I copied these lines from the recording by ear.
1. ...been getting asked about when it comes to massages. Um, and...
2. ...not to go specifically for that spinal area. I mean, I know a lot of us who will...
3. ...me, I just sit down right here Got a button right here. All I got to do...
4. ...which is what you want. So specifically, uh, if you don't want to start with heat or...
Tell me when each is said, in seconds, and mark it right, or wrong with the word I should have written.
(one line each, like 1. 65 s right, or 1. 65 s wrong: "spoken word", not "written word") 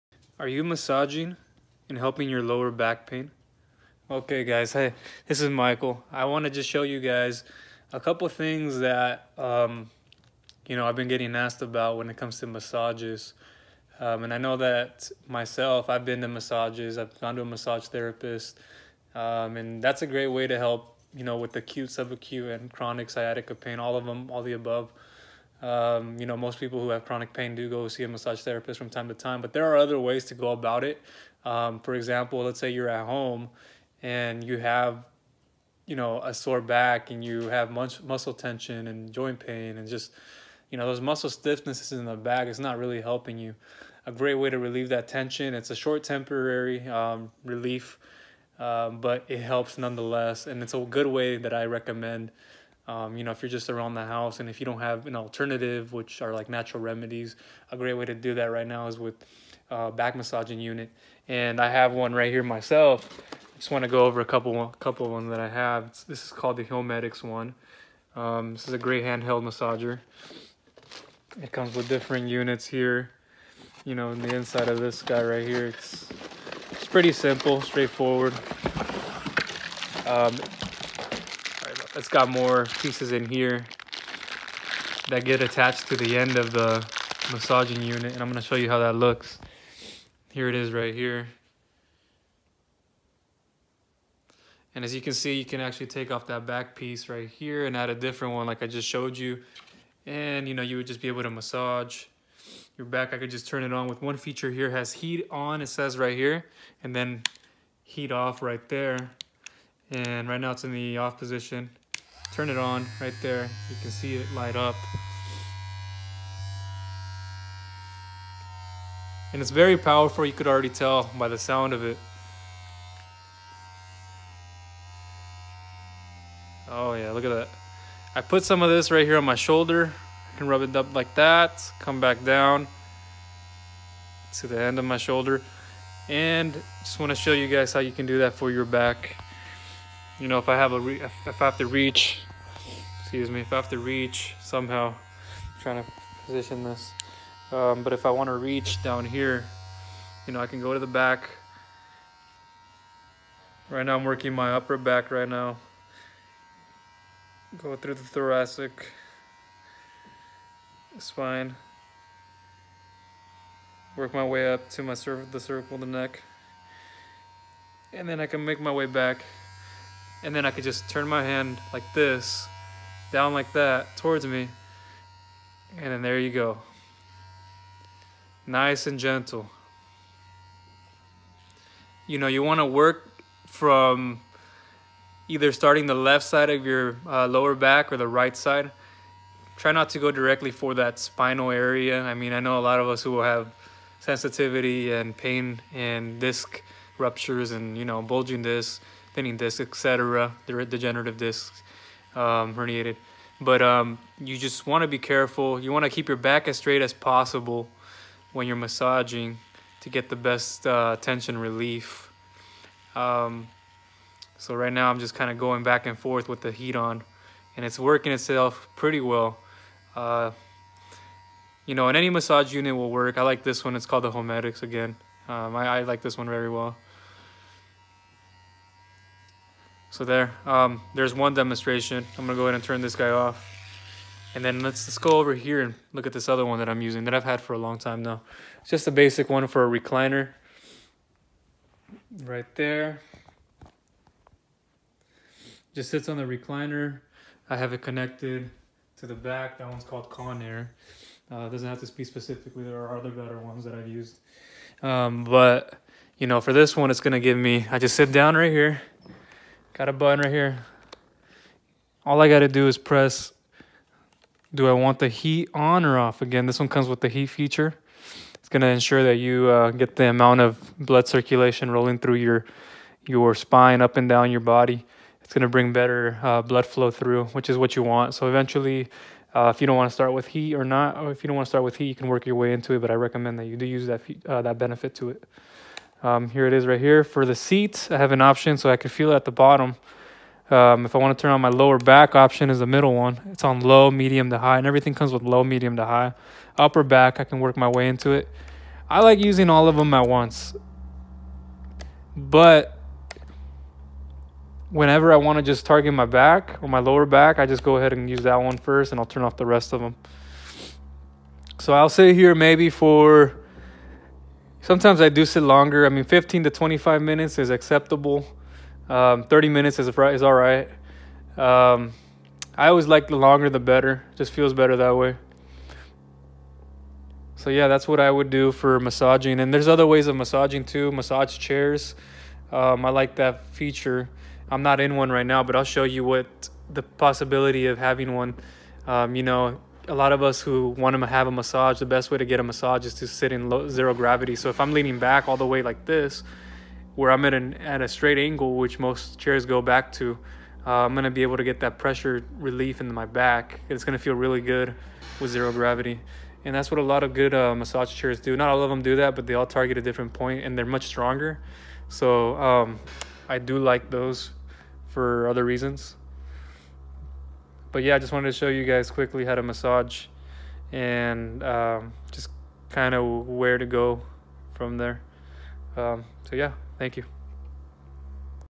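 1. 10 s right
2. 189 s wrong: "directly", not "specifically"
3. 257 s right
4. 277 s wrong: "eventually", not "specifically".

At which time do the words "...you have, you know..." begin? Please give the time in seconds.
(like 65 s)
34 s.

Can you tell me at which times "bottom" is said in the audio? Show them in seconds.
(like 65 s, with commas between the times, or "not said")
289 s.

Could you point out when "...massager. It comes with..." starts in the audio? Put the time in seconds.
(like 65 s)
69 s.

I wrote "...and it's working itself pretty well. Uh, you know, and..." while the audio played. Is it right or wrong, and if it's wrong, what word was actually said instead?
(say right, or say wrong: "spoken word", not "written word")
right.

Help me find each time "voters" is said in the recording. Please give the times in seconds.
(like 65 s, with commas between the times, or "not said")
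not said.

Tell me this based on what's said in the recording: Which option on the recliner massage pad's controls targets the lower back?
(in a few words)
The middle one.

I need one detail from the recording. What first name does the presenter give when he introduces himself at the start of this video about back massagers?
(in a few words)
Michael.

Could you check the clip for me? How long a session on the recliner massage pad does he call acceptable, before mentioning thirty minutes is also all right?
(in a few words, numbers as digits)
15 to 25 minutes.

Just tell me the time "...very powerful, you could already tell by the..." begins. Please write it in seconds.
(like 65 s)
119 s.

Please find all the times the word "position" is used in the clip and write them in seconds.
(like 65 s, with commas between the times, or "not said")
111 s, 146 s.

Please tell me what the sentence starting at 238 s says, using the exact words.
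It's just a basic one for a recliner.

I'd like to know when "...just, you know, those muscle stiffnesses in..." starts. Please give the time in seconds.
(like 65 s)
39 s.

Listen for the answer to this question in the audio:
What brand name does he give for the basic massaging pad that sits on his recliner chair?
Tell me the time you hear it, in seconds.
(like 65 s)
250 s.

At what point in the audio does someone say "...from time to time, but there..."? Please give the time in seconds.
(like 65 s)
28 s.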